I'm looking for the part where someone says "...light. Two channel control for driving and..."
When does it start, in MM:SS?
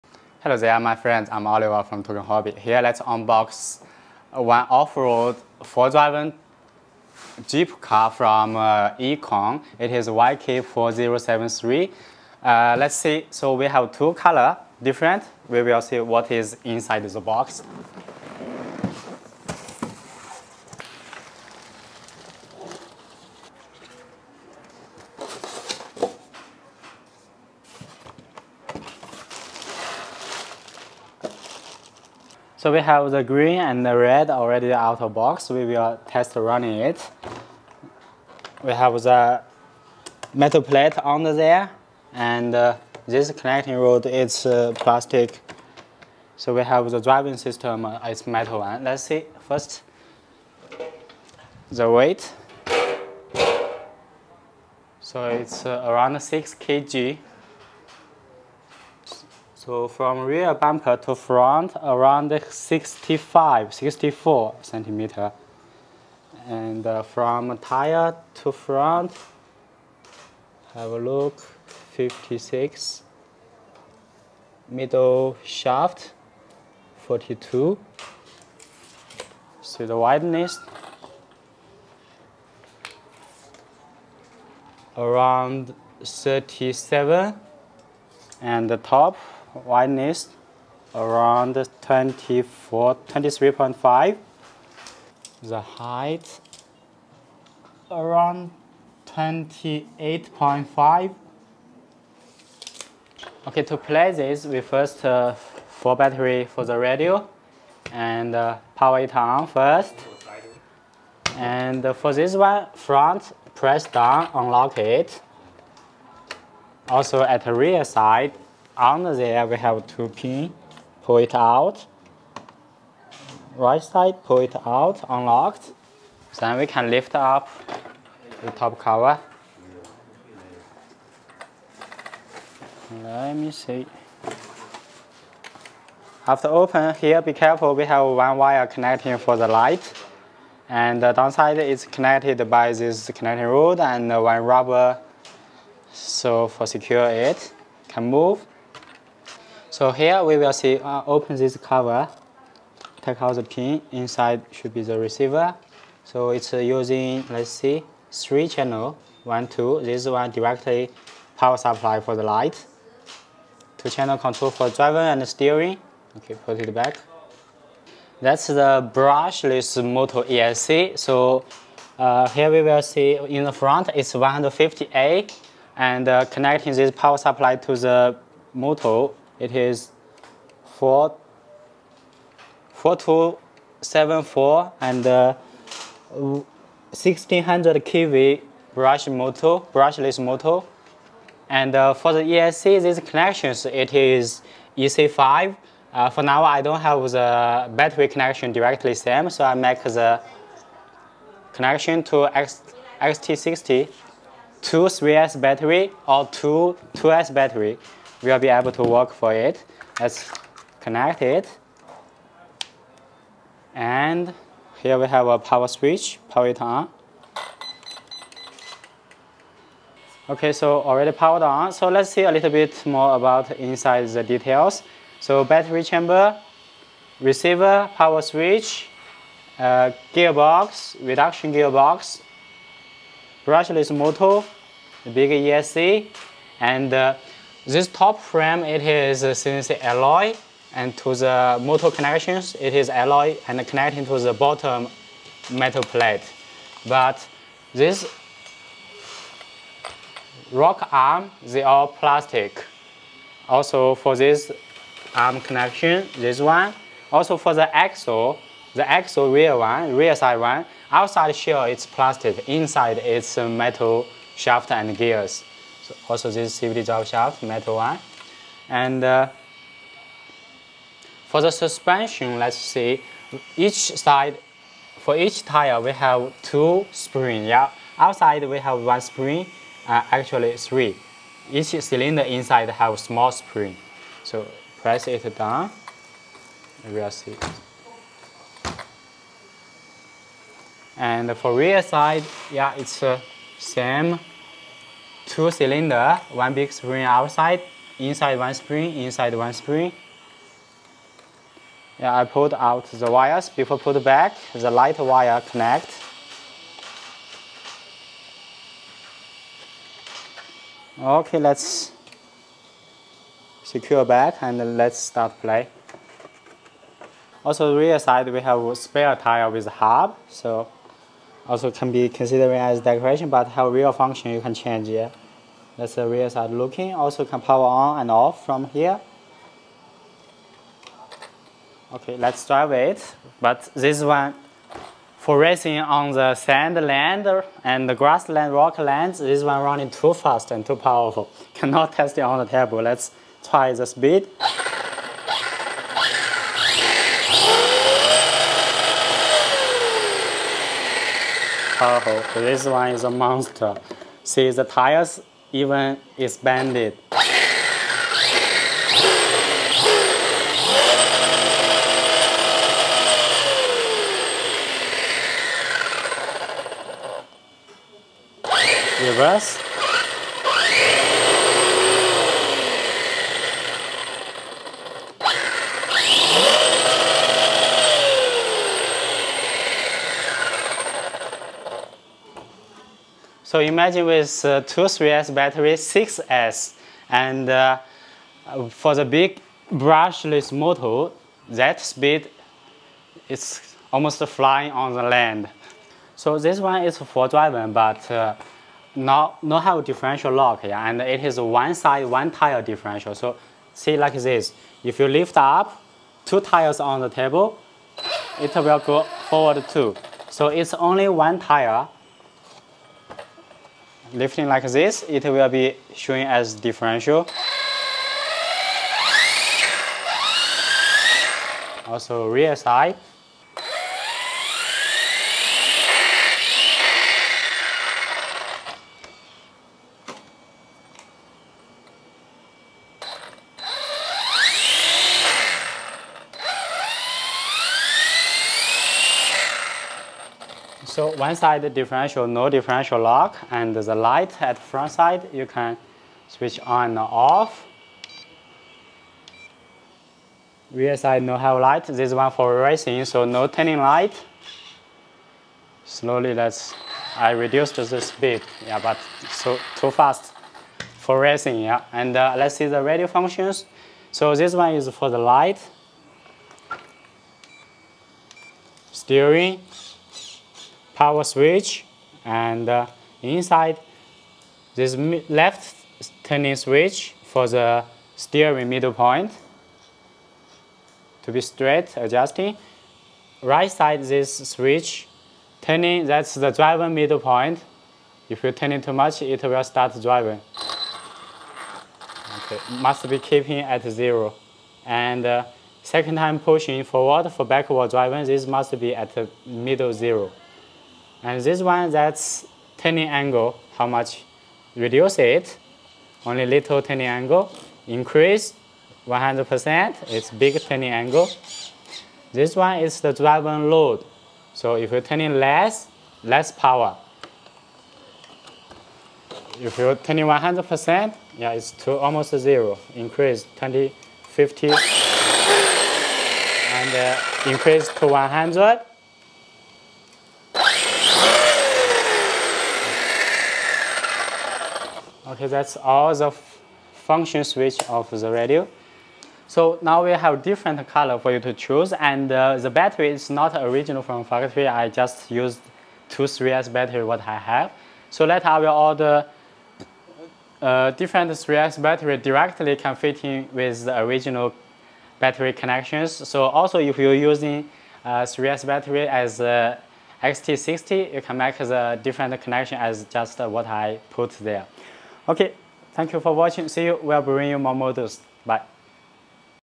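02:42.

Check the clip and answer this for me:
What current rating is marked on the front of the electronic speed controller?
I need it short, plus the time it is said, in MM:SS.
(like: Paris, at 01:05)
150A, at 02:54.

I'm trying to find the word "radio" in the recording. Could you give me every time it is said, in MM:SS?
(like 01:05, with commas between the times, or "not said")
01:46, 07:42, 08:58.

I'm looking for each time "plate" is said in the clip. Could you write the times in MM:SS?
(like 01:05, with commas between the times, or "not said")
00:40, 04:05.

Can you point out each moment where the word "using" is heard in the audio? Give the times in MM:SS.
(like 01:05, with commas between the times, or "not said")
02:36, 09:17.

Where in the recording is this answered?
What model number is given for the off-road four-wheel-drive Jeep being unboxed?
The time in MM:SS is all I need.
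00:10.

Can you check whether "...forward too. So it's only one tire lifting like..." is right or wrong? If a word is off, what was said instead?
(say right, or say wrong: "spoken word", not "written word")
right.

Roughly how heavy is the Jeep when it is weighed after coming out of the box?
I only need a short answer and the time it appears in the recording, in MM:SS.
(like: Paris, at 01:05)
6 kg, at 00:56.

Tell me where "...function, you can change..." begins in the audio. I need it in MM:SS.
05:23.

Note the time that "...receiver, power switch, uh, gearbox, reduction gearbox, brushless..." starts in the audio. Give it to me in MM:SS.
03:47.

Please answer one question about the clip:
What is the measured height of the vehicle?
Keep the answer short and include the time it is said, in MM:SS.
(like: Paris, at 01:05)
28.5, at 01:39.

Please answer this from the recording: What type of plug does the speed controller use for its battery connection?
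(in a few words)
EC5.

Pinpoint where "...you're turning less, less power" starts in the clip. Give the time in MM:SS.
08:34.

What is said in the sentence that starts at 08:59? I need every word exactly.
So now we have different color for you to choose and uh, the battery is not original from factory.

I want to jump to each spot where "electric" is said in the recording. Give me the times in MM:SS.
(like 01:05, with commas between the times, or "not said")
not said.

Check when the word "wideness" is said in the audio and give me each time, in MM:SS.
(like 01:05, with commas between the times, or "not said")
01:19, 01:29.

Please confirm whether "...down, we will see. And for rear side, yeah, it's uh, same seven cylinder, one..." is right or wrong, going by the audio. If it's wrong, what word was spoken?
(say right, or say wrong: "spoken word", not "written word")
wrong: "two", not "seven".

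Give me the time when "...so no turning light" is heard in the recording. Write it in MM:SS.
07:33.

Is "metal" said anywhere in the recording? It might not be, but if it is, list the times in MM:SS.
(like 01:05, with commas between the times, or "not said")
00:40, 00:48, 04:05, 04:23, 04:27.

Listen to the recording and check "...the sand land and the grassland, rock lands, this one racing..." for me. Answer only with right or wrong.
wrong.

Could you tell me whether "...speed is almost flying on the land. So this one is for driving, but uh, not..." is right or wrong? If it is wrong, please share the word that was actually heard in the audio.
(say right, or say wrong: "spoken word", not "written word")
right.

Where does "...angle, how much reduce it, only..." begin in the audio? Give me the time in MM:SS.
08:23.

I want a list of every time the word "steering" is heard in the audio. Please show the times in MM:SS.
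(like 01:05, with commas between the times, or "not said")
02:45, 07:48, 07:58.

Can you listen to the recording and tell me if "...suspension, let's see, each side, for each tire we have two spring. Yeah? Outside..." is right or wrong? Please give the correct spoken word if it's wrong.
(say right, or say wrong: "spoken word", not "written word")
right.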